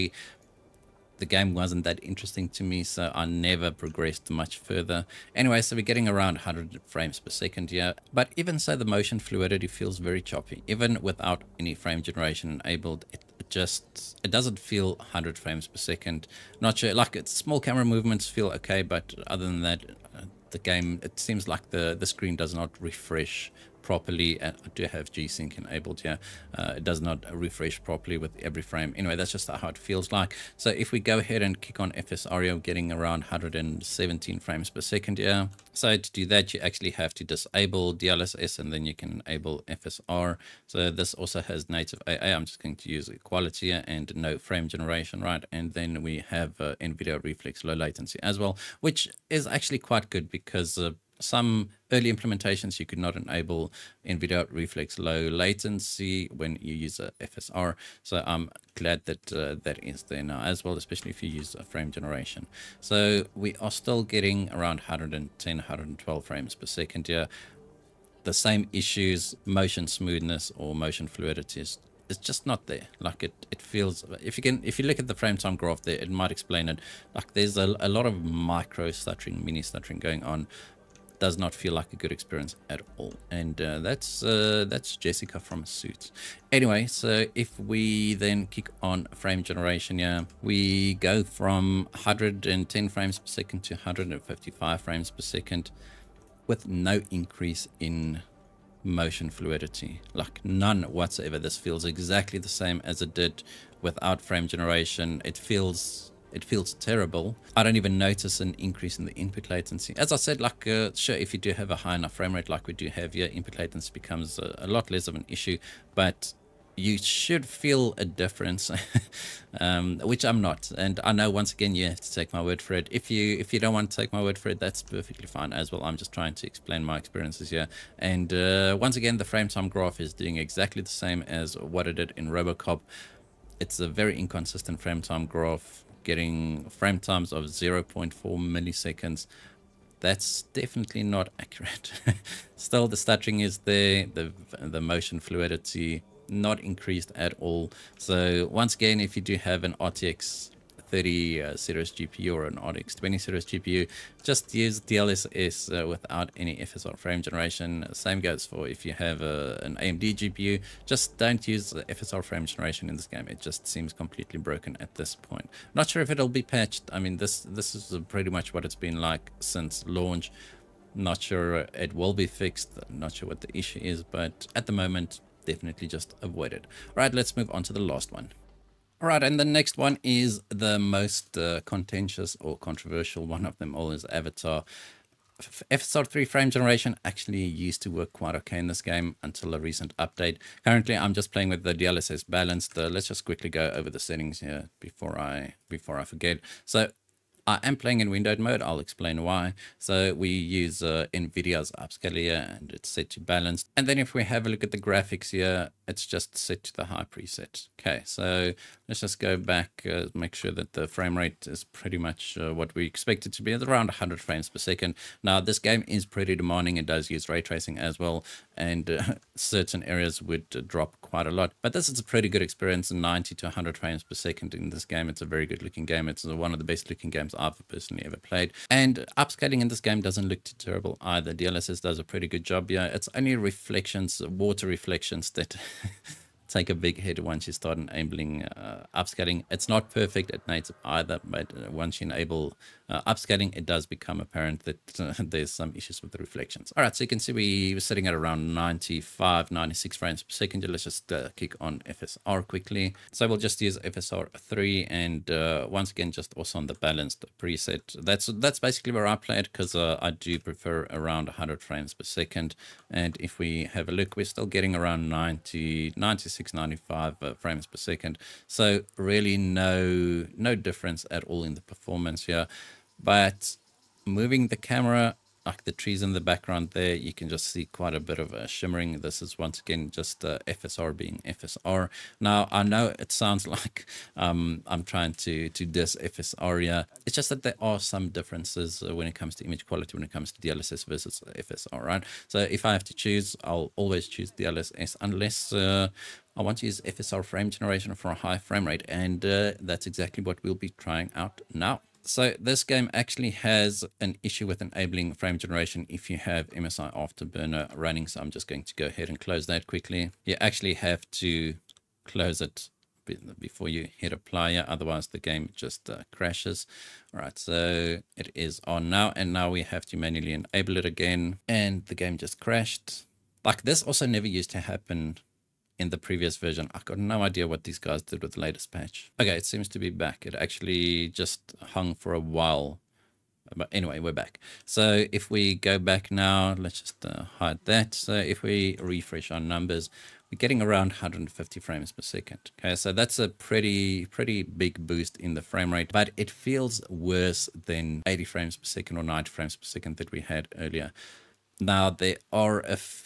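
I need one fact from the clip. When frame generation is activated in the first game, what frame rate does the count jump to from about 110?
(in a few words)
155.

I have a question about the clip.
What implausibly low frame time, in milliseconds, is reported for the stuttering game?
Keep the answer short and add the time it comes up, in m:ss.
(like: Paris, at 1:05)
0.4 milliseconds, at 2:17.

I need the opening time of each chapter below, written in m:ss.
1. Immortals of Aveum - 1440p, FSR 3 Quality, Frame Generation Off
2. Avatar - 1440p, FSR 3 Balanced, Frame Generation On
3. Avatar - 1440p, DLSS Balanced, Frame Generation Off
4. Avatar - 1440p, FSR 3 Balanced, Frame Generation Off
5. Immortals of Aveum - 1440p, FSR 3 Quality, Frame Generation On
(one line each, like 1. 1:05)
1. 1:00
2. 5:37
3. 2:58
4. 4:22
5. 1:31.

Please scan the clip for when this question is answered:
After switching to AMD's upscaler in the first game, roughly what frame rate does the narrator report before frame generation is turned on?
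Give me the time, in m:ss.
0:33.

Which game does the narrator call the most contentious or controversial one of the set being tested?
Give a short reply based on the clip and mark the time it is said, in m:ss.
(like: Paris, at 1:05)
Avatar, at 3:04.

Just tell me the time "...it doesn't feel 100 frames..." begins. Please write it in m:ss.
0:14.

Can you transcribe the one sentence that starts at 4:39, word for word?
This is once again just uh, FSR being FSR.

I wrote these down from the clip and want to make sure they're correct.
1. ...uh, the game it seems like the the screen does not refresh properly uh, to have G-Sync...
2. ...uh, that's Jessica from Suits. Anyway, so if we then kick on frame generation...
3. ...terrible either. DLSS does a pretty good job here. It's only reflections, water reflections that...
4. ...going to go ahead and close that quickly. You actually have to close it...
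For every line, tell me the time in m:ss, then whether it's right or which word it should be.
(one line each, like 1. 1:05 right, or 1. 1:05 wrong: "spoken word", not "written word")
1. 0:20 right
2. 1:24 right
3. 3:50 right
4. 5:08 right.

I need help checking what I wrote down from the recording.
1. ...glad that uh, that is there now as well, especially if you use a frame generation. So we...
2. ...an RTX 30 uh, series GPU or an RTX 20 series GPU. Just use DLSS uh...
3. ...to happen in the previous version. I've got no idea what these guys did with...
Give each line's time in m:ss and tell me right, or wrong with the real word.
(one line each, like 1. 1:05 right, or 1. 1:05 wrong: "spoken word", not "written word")
1. 0:58 right
2. 2:29 right
3. 5:24 right.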